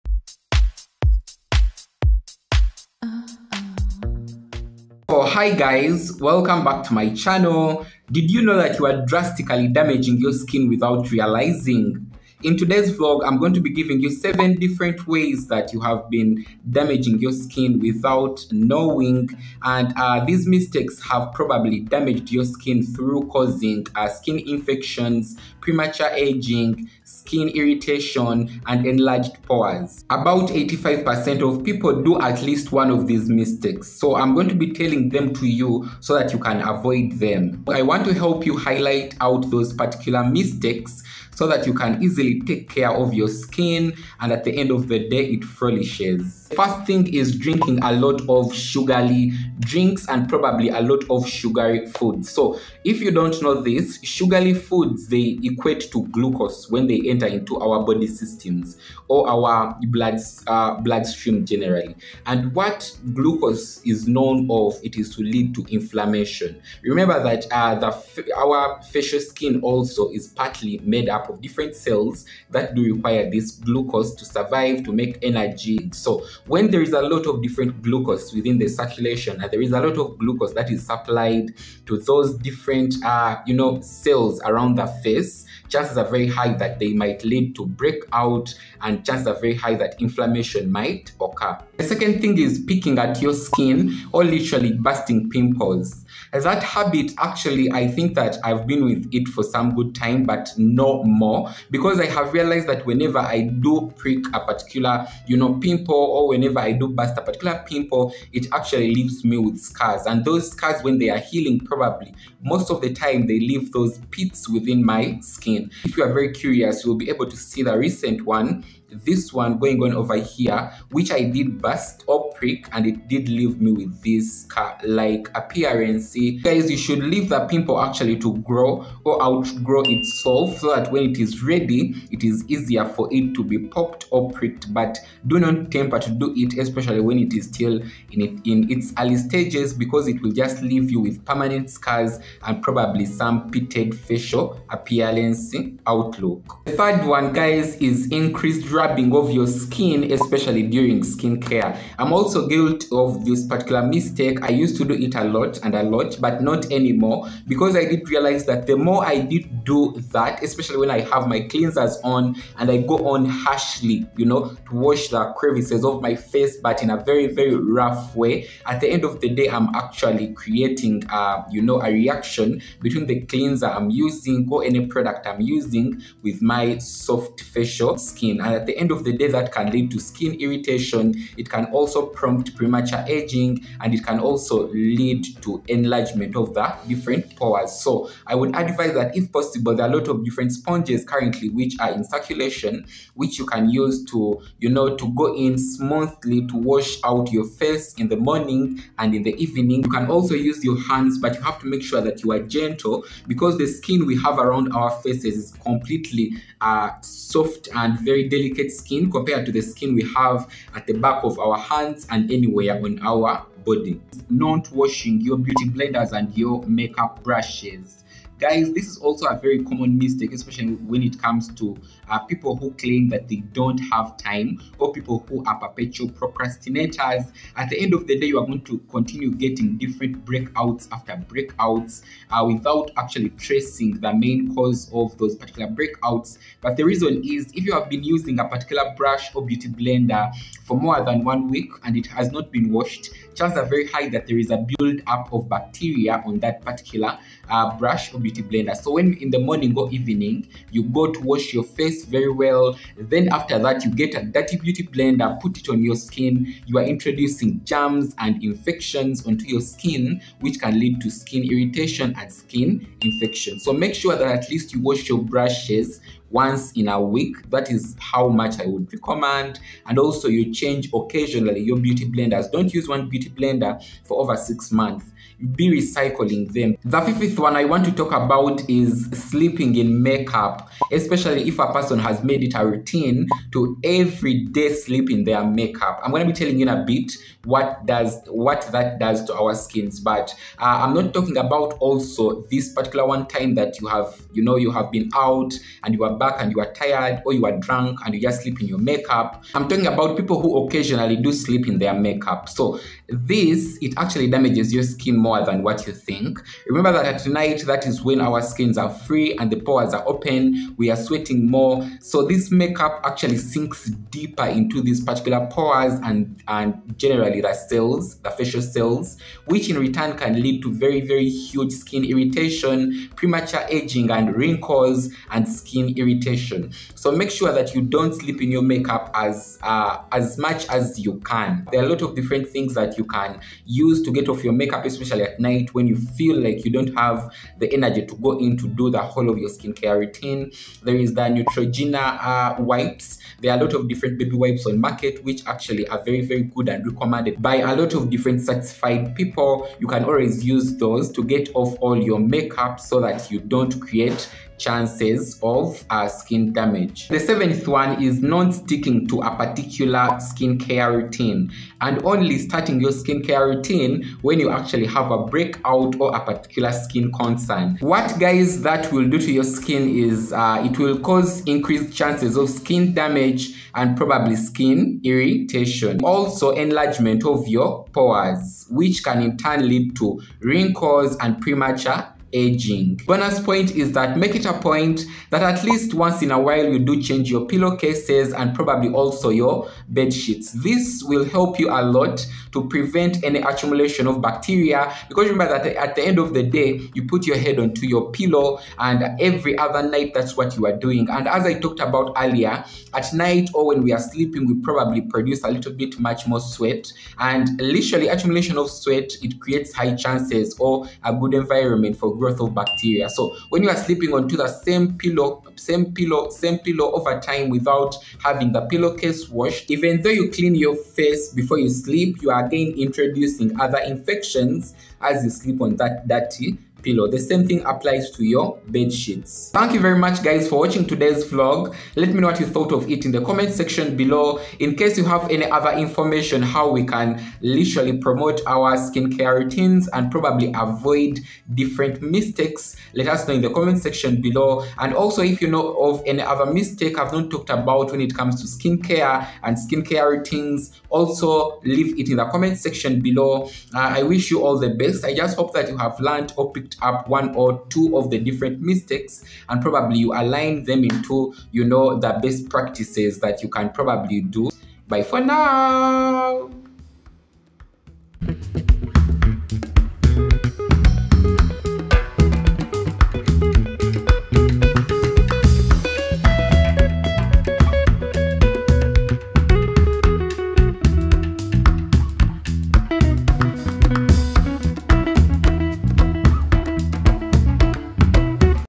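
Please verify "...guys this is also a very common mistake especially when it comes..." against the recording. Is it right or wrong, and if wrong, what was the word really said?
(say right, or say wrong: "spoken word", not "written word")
right.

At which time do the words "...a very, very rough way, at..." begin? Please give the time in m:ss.
2:46.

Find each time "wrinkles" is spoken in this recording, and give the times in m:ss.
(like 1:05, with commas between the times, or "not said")
5:24, 6:20.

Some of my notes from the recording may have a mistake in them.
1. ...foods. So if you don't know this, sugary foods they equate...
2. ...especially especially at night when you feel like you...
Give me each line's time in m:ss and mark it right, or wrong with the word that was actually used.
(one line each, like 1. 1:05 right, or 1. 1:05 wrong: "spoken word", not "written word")
1. 0:51 right
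2. 5:34 right.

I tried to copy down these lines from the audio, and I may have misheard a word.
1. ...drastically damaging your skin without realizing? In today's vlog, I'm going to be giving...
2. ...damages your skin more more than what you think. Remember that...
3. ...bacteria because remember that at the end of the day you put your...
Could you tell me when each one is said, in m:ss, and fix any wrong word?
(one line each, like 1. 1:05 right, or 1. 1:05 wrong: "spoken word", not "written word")
1. 0:09 right
2. 5:04 right
3. 6:34 right.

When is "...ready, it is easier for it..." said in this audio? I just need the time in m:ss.
2:11.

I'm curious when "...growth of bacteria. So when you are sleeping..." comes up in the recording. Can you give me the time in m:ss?
6:52.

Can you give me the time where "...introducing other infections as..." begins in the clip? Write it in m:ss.
7:02.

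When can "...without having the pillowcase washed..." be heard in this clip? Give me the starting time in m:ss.
6:57.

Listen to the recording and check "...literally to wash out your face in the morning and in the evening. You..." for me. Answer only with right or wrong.
wrong.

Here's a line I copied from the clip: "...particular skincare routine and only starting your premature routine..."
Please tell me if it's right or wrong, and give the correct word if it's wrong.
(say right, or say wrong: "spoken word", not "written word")
wrong: "skincare", not "premature".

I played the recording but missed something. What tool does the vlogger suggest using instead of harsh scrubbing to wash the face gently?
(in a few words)
sponges.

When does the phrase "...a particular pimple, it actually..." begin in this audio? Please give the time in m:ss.
1:47.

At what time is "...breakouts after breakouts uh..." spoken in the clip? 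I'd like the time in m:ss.
3:50.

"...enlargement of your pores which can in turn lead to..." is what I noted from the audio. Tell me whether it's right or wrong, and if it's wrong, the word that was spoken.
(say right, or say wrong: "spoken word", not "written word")
right.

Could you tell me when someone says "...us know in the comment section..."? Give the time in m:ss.
7:23.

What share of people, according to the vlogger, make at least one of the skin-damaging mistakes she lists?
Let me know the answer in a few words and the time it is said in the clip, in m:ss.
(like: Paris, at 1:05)
85%, at 0:30.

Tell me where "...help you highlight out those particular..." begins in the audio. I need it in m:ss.
0:38.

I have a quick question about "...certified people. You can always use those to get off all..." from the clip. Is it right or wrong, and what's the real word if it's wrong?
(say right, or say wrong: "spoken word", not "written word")
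right.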